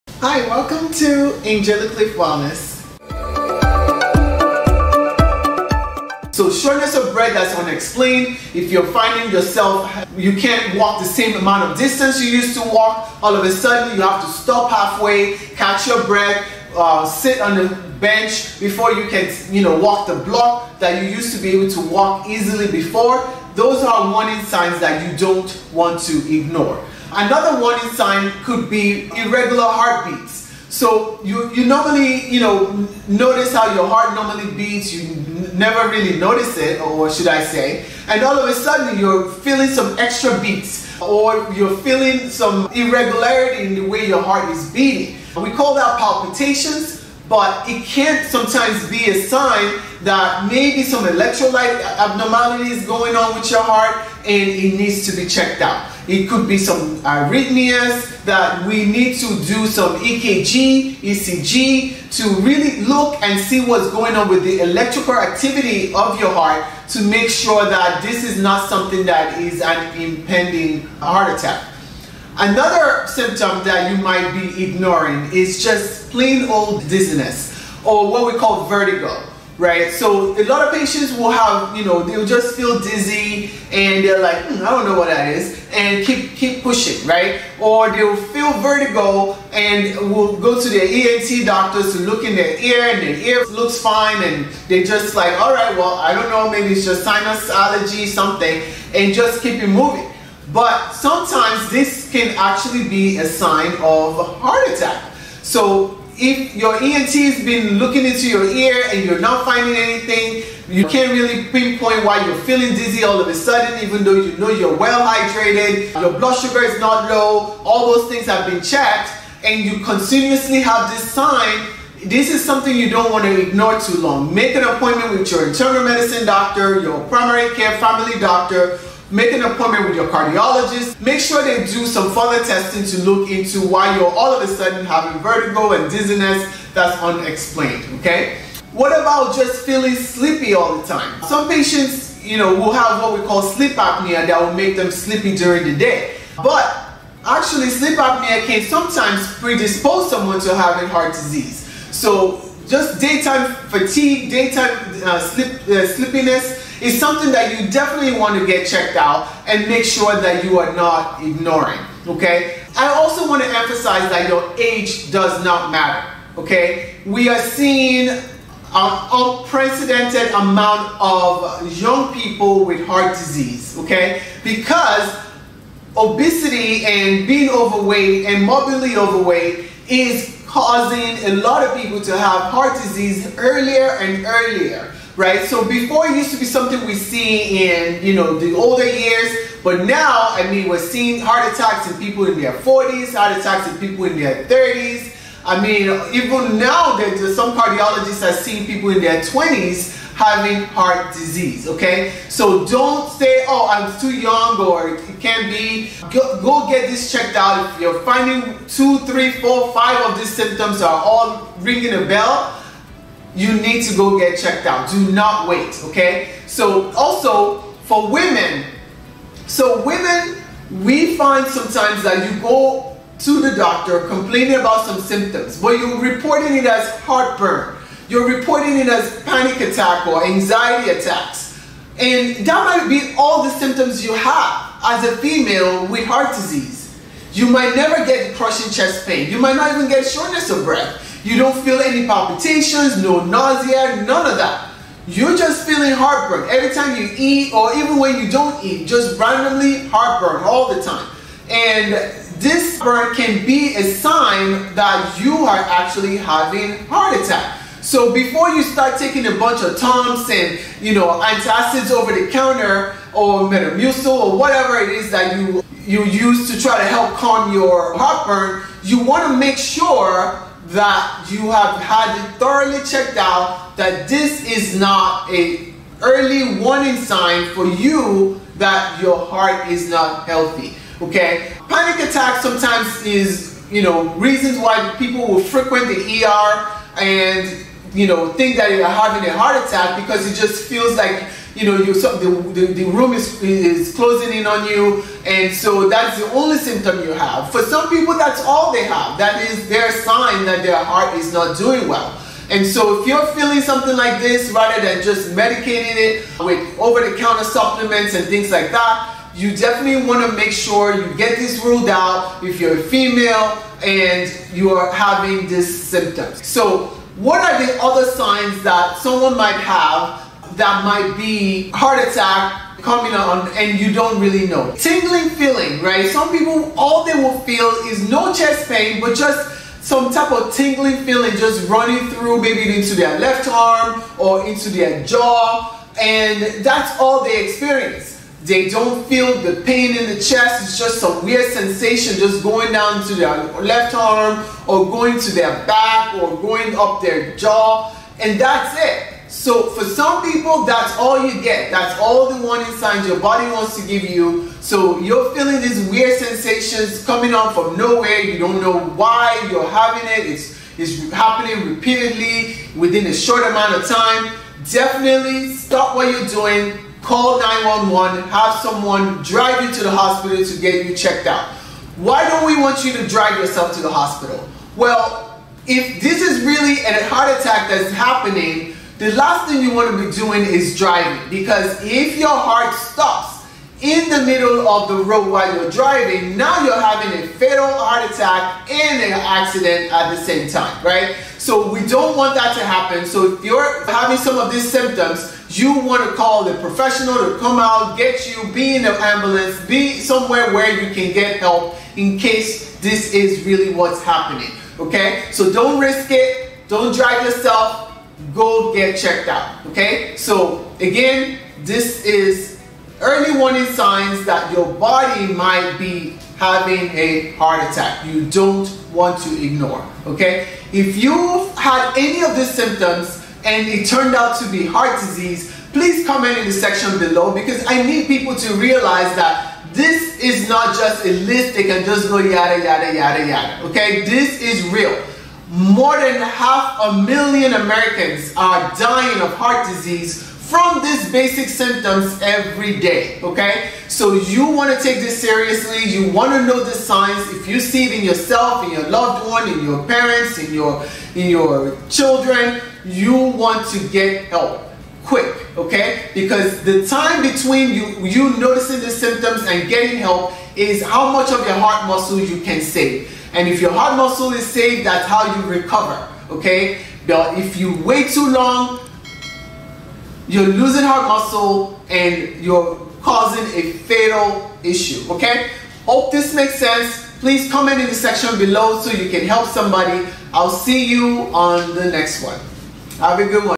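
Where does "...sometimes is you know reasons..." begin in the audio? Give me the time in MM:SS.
04:42.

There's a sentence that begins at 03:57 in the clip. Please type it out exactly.
You might never get crushing chest pain.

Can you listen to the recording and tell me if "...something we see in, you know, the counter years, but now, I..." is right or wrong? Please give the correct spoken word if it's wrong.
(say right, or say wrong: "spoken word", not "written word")
wrong: "older", not "counter".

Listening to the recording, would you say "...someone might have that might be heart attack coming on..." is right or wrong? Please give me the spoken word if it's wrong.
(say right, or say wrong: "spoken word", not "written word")
right.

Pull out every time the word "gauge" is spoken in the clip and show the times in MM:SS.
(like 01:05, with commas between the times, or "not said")
not said.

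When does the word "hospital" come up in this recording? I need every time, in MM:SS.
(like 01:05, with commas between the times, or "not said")
06:09, 06:13.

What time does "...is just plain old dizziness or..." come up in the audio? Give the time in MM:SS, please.
01:15.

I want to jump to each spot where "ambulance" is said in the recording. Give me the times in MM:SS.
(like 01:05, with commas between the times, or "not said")
06:38.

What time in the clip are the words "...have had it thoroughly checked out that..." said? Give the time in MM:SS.
04:31.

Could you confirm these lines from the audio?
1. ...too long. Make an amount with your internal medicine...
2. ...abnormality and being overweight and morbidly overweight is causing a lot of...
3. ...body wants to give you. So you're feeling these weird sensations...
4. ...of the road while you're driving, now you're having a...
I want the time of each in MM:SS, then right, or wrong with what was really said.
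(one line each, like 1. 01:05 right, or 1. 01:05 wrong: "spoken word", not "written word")
1. 02:03 wrong: "appointment", not "amount"
2. 02:55 wrong: "obesity", not "abnormality"
3. 05:53 right
4. 06:24 right.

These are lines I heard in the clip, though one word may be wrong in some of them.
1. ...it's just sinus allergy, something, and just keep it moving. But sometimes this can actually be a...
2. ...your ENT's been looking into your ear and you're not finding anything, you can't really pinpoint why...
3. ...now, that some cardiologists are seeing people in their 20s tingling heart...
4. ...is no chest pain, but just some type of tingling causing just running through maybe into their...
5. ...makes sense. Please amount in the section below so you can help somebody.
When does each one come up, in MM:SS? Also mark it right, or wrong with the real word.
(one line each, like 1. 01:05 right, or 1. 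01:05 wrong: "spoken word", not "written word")
1. 01:36 right
2. 01:46 right
3. 03:16 wrong: "having", not "tingling"
4. 05:27 wrong: "feeling", not "causing"
5. 07:56 wrong: "comment", not "amount".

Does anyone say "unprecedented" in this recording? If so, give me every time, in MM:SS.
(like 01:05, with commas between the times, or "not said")
02:48.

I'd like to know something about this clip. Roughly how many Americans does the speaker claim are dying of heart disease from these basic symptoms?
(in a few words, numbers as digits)
half a million.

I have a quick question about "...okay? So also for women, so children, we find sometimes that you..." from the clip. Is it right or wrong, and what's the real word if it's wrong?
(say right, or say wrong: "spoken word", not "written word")
wrong: "women", not "children".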